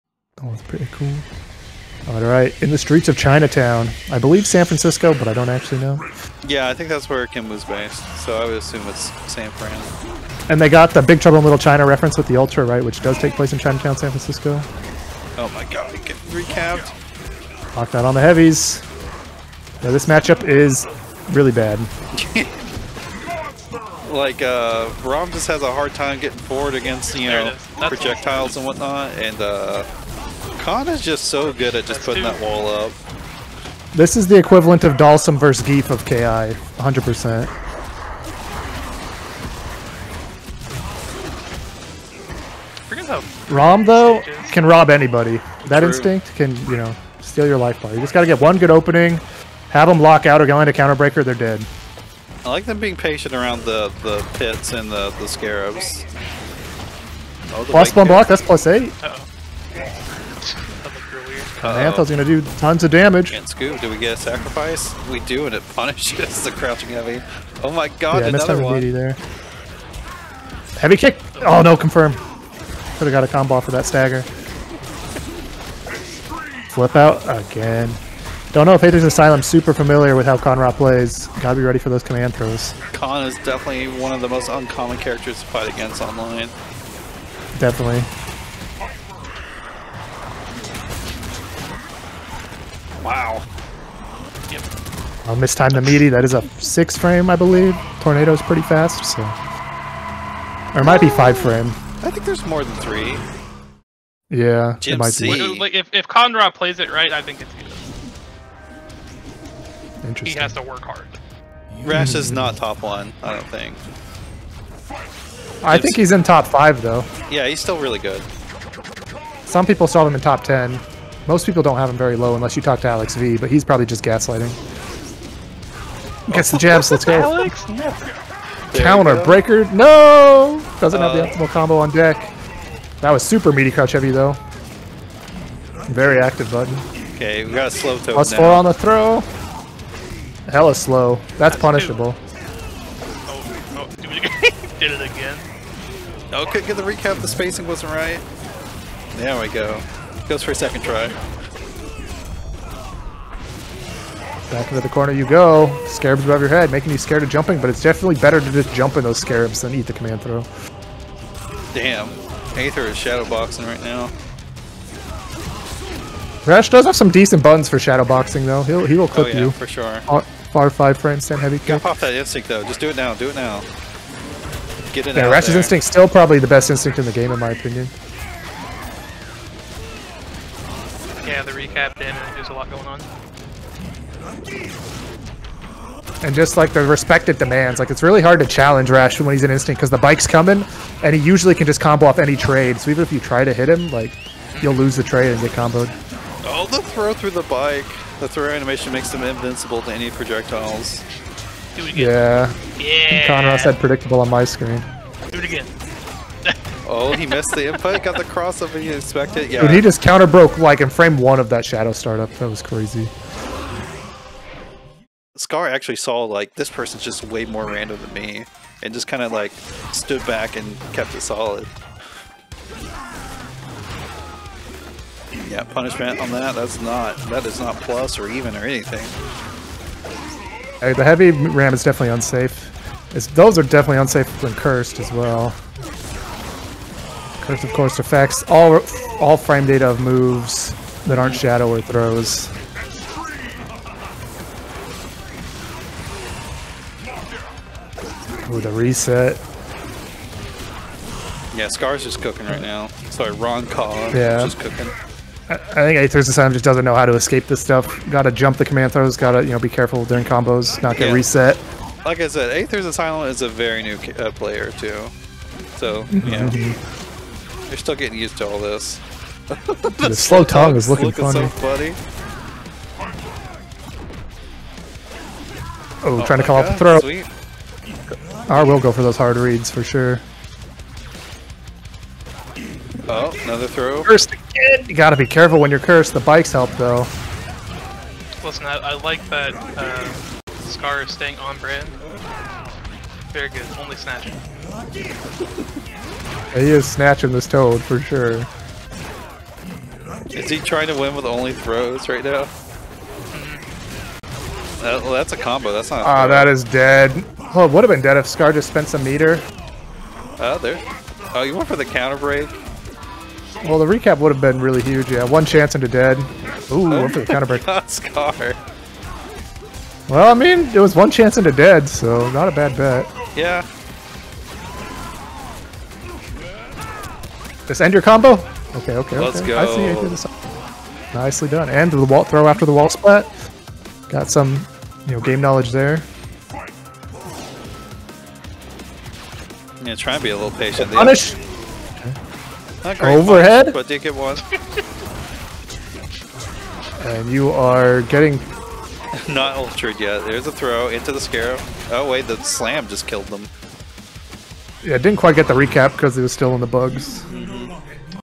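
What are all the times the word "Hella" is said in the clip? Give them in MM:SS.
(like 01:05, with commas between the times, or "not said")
02:20.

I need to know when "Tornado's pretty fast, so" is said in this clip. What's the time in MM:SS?
01:38.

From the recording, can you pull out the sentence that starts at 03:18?
The throw animation makes him invincible to any projectiles.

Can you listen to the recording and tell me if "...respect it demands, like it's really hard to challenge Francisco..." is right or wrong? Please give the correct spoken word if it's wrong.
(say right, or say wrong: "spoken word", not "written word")
wrong: "Rash", not "Francisco".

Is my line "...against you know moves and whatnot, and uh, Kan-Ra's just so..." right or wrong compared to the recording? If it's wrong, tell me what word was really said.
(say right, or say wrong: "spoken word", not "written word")
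wrong: "projectiles", not "moves".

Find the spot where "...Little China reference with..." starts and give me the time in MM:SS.
00:11.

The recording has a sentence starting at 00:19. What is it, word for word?
Now this matchup is really bad.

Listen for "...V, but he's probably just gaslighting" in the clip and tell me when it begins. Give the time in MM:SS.
02:03.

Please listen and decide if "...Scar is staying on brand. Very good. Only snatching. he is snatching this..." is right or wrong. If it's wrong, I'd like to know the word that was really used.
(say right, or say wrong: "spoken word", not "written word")
right.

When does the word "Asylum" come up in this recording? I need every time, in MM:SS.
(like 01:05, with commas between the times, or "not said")
01:19, 04:16, 04:22.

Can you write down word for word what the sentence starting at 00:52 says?
I like them being patient around the the pits and the the scarabs.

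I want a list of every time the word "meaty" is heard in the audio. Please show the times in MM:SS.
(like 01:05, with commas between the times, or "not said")
01:35, 02:13.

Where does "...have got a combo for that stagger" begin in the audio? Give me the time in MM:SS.
01:13.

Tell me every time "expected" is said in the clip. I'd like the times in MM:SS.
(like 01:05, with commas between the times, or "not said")
03:28.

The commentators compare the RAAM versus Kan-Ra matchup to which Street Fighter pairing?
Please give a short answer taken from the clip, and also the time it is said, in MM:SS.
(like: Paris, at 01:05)
Dhalsim versus Gief, at 00:34.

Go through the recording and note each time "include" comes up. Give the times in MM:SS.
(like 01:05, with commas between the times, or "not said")
not said.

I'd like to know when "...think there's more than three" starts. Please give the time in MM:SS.
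01:42.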